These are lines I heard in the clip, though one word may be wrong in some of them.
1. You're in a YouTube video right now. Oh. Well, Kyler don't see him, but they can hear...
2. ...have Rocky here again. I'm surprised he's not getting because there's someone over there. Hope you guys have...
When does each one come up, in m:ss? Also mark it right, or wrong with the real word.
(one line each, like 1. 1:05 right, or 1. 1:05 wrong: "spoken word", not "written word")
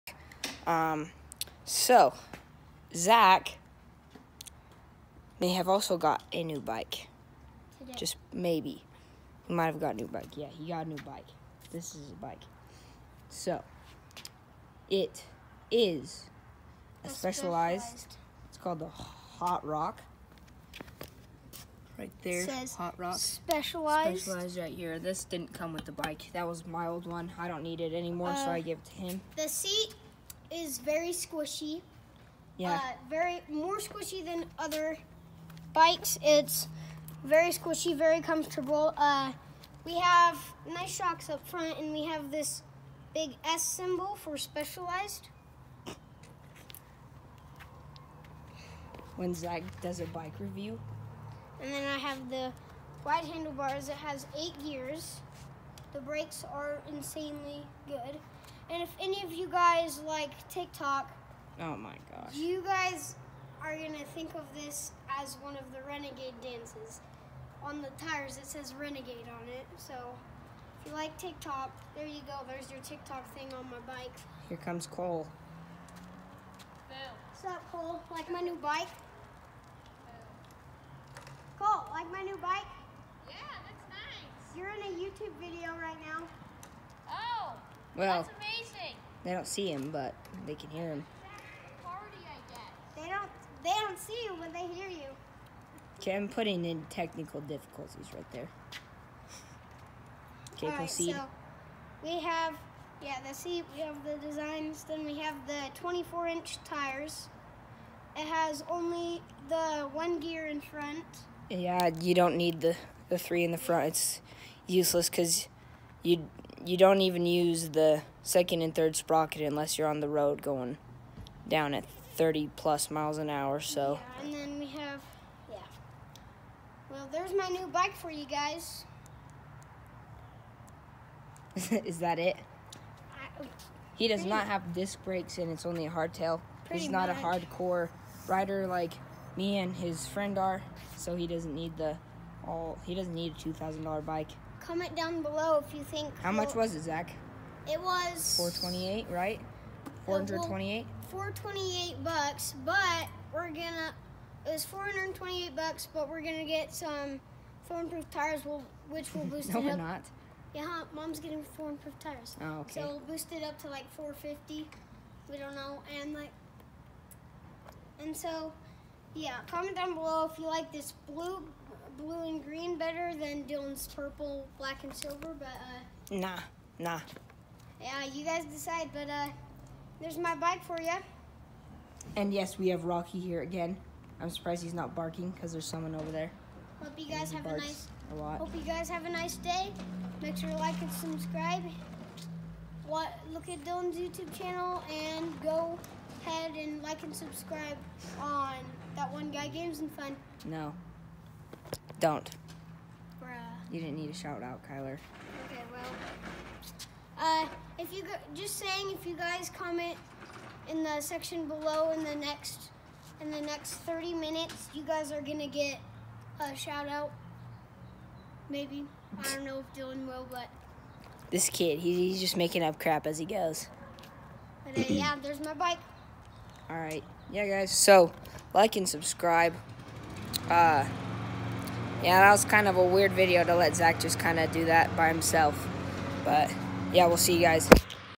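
1. 1:24 wrong: "They", not "Kyler"
2. 3:02 wrong: "barking", not "getting".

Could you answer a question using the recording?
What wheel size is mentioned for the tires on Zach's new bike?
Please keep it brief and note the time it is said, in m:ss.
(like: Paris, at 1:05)
24-inch, at 1:45.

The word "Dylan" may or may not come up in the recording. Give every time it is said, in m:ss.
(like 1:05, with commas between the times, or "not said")
2:53, 3:13, 3:39.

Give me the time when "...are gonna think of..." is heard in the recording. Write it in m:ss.
1:03.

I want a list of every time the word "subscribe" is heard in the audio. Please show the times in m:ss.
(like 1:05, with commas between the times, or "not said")
3:10, 3:17, 3:48.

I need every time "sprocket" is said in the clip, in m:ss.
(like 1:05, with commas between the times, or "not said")
1:58.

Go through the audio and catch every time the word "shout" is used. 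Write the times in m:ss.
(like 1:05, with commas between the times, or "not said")
3:24, 3:36.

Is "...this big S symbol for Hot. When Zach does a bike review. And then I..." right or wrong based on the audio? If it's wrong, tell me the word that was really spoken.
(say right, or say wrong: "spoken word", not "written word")
wrong: "Specialized", not "Hot".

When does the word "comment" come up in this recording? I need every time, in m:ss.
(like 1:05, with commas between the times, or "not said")
2:24, 2:49, 3:29.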